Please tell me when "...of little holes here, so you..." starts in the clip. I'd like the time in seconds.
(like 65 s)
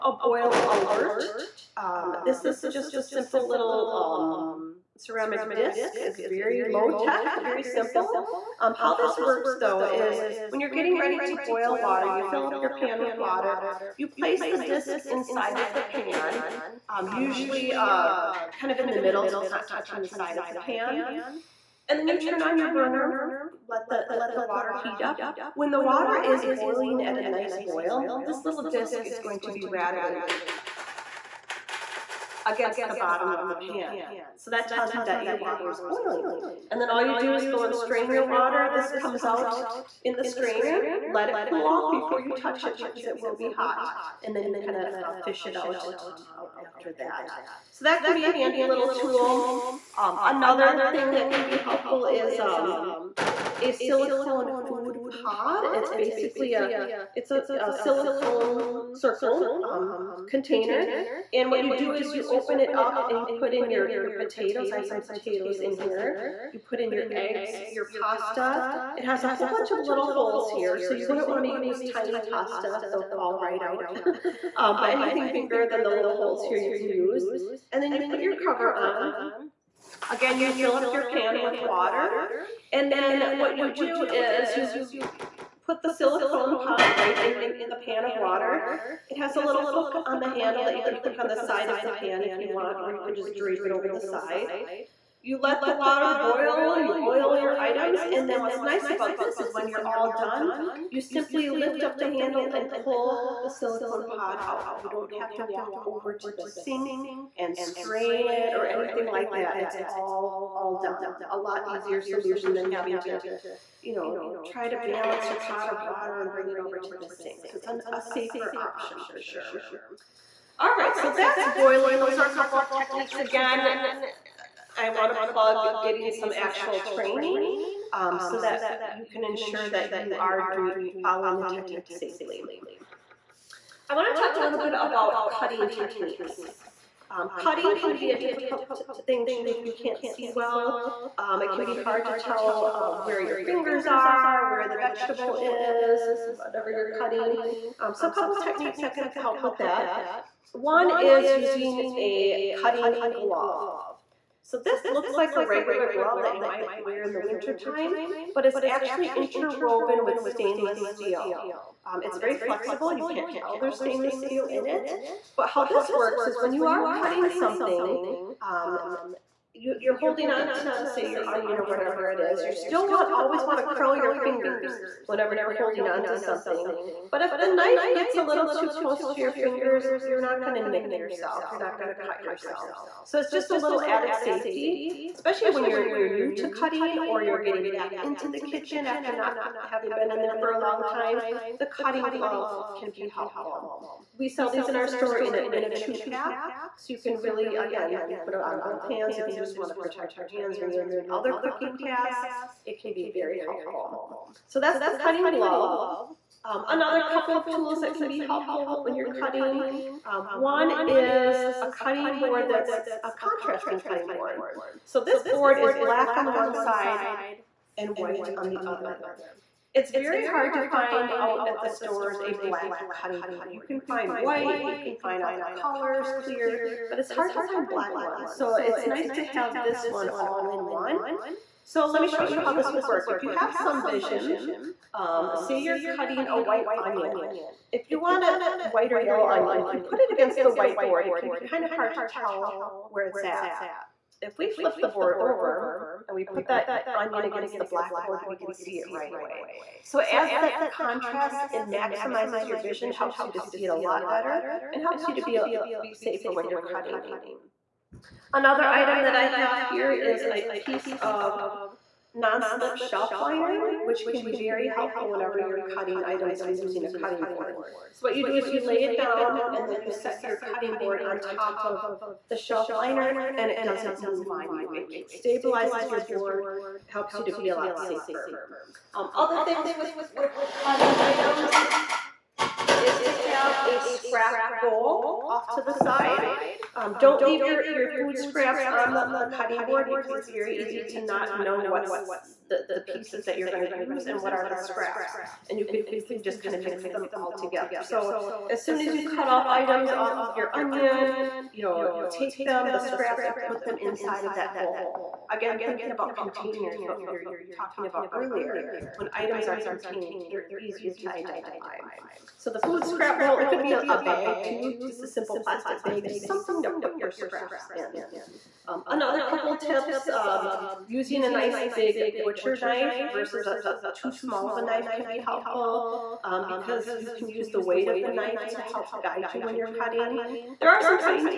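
69 s.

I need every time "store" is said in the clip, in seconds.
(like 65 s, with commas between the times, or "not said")
194 s, 221 s.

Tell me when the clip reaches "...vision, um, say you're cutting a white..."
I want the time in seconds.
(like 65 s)
233 s.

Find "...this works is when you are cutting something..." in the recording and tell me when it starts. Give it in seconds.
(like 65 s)
165 s.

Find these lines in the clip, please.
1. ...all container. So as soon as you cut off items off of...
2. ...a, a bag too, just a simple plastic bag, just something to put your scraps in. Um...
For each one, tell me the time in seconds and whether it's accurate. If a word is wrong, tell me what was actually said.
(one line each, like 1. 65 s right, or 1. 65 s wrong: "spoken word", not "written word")
1. 297 s wrong: "together", not "container"
2. 313 s right.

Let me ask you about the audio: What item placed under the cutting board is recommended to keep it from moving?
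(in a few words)
non-slip shelf liner.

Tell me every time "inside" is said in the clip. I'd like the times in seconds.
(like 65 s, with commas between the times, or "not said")
15 s, 303 s.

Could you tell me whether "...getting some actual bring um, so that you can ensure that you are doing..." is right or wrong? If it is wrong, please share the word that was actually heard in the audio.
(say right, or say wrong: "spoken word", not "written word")
wrong: "training", not "bring".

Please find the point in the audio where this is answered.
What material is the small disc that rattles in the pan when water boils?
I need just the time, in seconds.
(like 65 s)
4 s.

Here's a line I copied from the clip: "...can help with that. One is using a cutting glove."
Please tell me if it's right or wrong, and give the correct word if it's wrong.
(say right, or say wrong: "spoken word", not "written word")
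right.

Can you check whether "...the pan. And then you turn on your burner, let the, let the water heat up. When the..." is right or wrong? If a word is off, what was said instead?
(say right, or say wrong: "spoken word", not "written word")
right.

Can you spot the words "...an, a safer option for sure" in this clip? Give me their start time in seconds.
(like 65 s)
117 s.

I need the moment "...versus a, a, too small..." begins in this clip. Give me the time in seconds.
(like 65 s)
323 s.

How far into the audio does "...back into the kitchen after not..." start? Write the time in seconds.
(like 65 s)
187 s.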